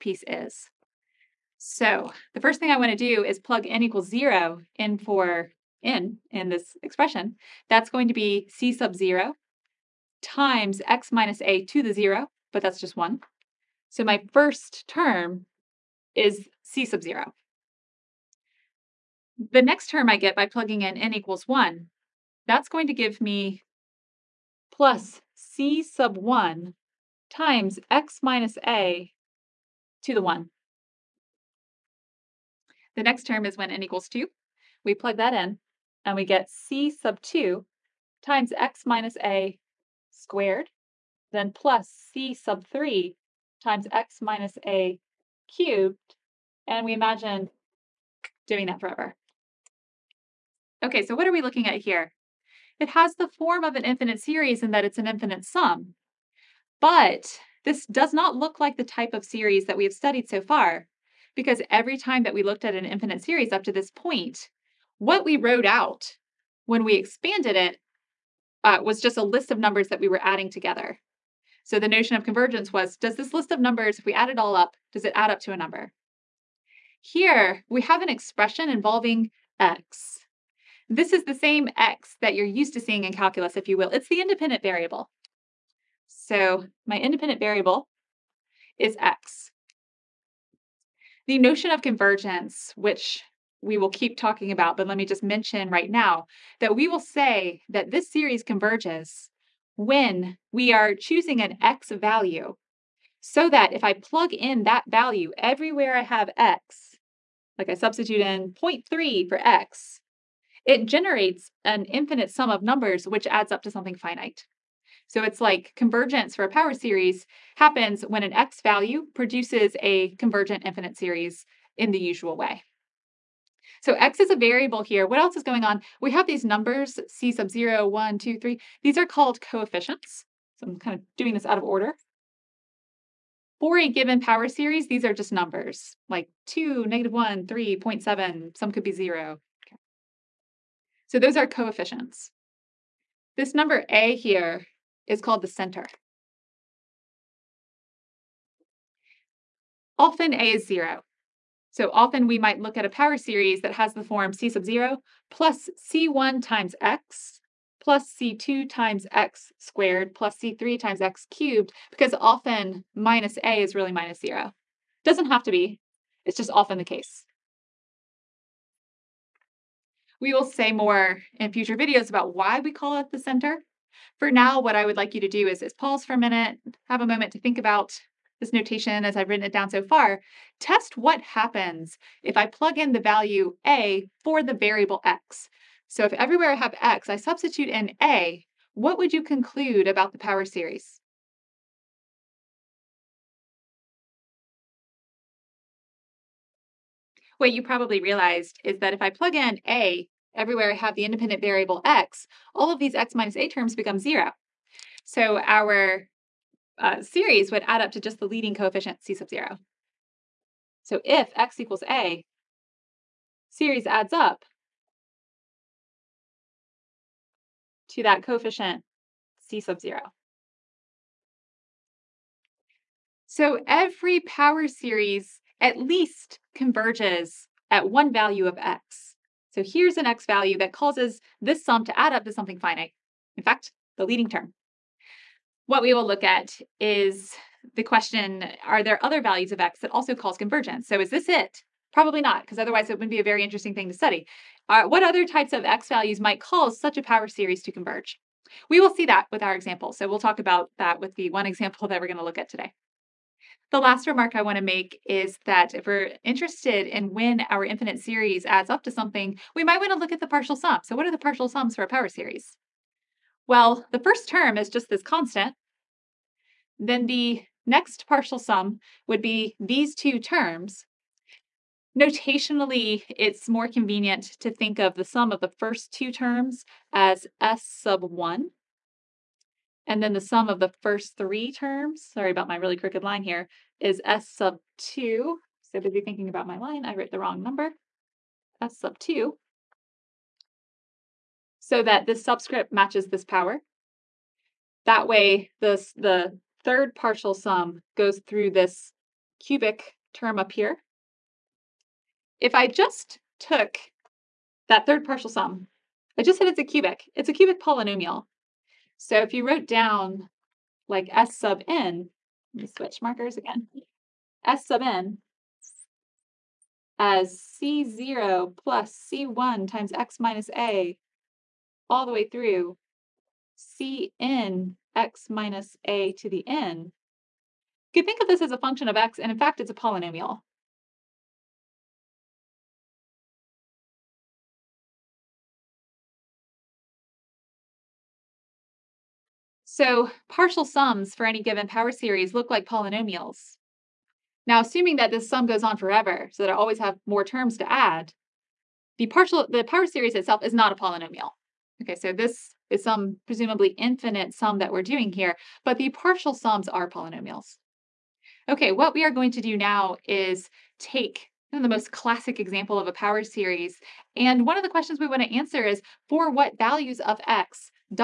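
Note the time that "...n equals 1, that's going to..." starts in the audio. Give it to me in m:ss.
0:20.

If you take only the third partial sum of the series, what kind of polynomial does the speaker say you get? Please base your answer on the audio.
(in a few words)
cubic polynomial.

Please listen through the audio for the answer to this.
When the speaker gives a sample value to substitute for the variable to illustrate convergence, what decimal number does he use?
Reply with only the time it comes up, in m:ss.
1:48.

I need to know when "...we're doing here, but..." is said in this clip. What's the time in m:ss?
5:54.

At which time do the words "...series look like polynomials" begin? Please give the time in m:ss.
5:41.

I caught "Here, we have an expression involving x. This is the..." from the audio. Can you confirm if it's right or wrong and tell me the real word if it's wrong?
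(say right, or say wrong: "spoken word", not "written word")
right.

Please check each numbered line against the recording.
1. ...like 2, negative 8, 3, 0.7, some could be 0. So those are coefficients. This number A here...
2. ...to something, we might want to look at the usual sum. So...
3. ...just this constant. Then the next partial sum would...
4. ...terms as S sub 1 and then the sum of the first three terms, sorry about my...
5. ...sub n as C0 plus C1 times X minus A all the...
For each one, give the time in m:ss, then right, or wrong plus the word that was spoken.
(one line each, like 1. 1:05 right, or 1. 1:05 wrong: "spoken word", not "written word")
1. 2:16 wrong: "1", not "8"
2. 4:18 wrong: "partial", not "usual"
3. 4:24 right
4. 4:36 right
5. 5:14 right.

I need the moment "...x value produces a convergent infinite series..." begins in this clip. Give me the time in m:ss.
1:58.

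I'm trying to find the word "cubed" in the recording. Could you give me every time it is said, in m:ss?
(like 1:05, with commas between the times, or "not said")
0:45, 2:41.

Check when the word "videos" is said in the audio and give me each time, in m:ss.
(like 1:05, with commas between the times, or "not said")
2:51.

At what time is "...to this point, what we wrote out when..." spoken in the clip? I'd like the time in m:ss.
1:03.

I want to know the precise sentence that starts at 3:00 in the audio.
Test what happens if I plug in the value a for the variable x.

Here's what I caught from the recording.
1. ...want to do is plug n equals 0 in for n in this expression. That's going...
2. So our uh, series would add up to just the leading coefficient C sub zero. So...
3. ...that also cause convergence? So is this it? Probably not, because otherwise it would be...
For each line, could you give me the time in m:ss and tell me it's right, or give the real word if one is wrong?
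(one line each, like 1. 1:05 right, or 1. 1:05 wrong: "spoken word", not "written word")
1. 0:02 right
2. 3:25 right
3. 3:59 right.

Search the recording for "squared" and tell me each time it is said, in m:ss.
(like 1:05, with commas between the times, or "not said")
0:40, 2:39.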